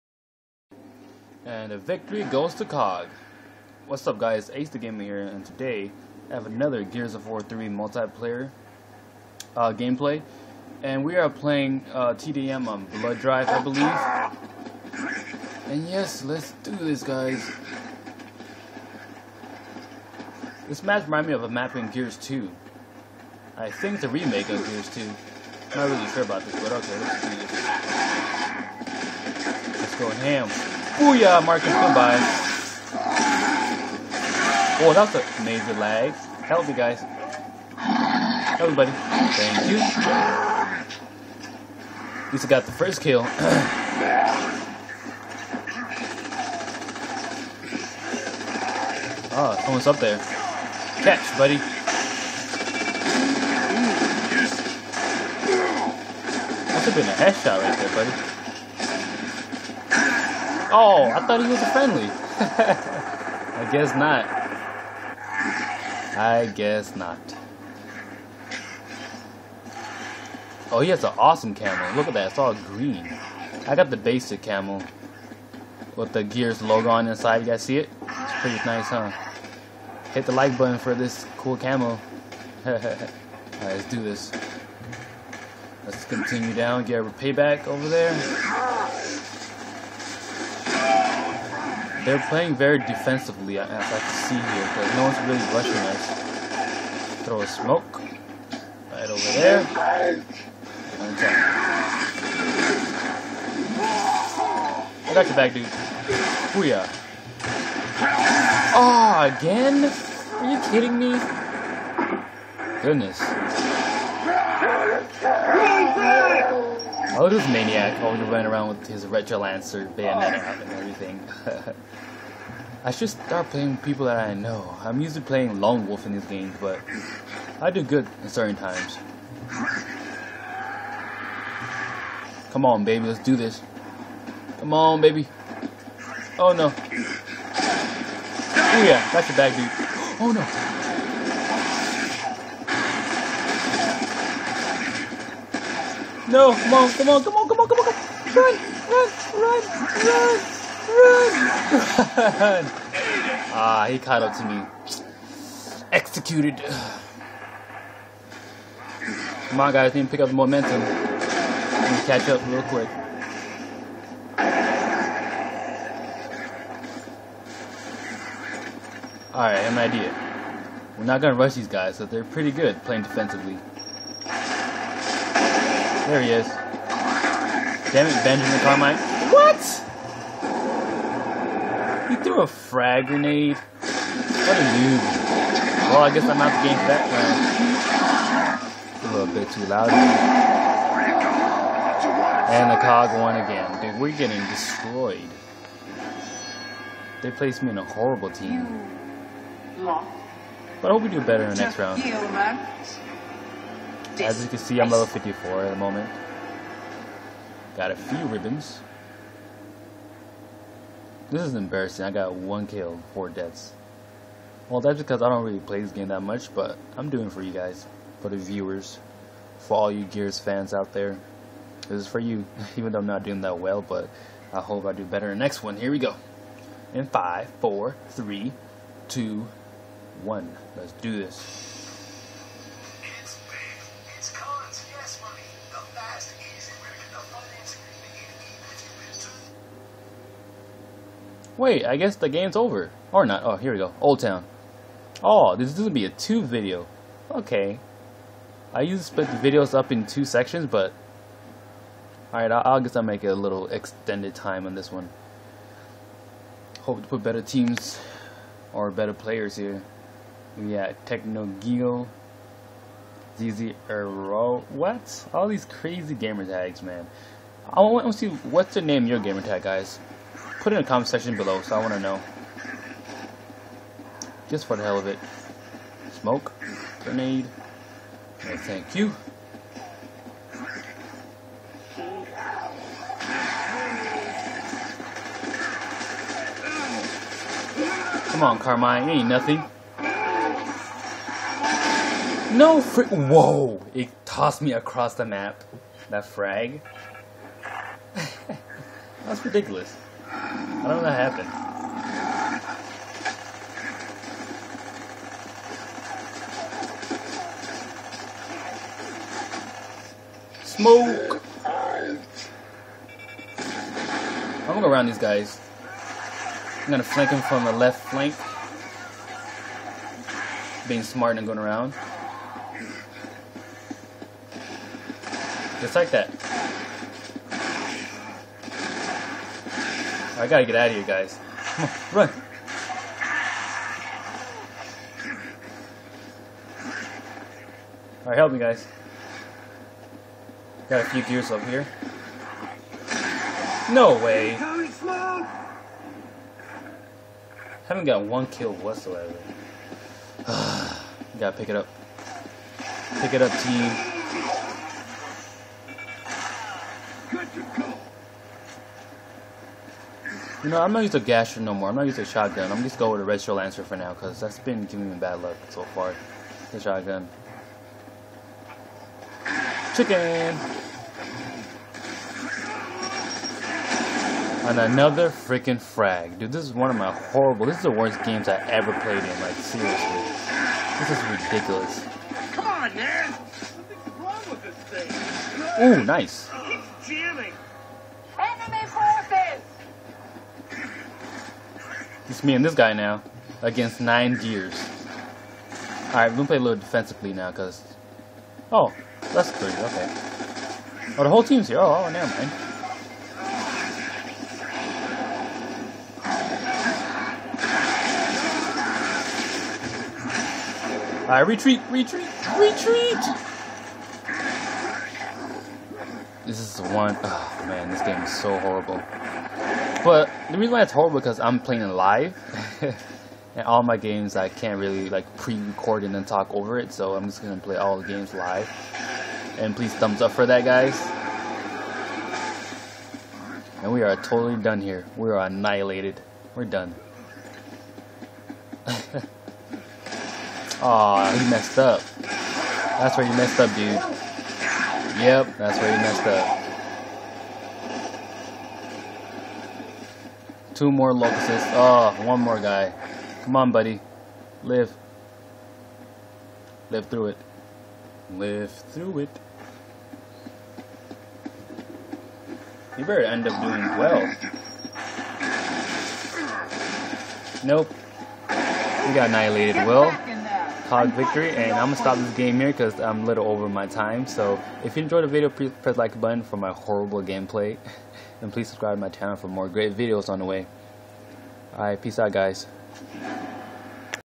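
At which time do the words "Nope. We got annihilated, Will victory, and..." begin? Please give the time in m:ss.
7:47.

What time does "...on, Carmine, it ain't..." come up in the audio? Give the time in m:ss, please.
4:48.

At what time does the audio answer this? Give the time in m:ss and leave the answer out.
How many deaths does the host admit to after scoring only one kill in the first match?
3:33.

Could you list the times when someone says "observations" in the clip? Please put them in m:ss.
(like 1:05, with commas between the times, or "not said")
not said.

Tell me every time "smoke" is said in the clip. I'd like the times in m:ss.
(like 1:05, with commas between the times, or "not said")
1:37, 4:36, 5:10.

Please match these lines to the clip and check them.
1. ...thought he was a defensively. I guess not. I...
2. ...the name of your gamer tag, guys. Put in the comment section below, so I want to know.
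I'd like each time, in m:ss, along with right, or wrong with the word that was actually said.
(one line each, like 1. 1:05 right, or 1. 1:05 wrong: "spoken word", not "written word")
1. 1:01 wrong: "friendly", not "defensively"
2. 4:28 right.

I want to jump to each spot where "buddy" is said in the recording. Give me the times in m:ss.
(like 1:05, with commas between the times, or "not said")
0:38, 0:51, 0:57, 7:33.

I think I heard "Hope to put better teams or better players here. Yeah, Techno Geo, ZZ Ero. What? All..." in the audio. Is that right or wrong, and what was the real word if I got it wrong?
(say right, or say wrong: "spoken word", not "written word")
right.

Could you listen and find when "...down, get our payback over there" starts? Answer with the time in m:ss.
1:26.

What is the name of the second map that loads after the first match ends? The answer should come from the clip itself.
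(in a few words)
Old Town.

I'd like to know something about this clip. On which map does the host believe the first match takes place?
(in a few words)
Blood Drive.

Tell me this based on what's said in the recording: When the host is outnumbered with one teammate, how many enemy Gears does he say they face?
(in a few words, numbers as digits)
9.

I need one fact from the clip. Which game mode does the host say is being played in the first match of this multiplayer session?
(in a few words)
TDM.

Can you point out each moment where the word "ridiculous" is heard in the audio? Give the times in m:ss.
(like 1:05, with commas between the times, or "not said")
4:59, 6:21.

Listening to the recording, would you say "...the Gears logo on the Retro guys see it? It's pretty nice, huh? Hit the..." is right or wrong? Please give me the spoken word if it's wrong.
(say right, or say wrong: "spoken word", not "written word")
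wrong: "You", not "Retro".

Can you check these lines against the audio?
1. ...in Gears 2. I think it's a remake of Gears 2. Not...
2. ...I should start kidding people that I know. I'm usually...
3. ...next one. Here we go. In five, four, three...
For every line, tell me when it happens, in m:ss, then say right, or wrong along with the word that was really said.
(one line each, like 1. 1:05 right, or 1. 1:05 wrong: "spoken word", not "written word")
1. 0:21 right
2. 2:02 wrong: "playing", not "kidding"
3. 3:45 right.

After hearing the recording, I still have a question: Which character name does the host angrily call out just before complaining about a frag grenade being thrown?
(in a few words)
Benjamin Carmine.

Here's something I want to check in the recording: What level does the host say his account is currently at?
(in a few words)
54.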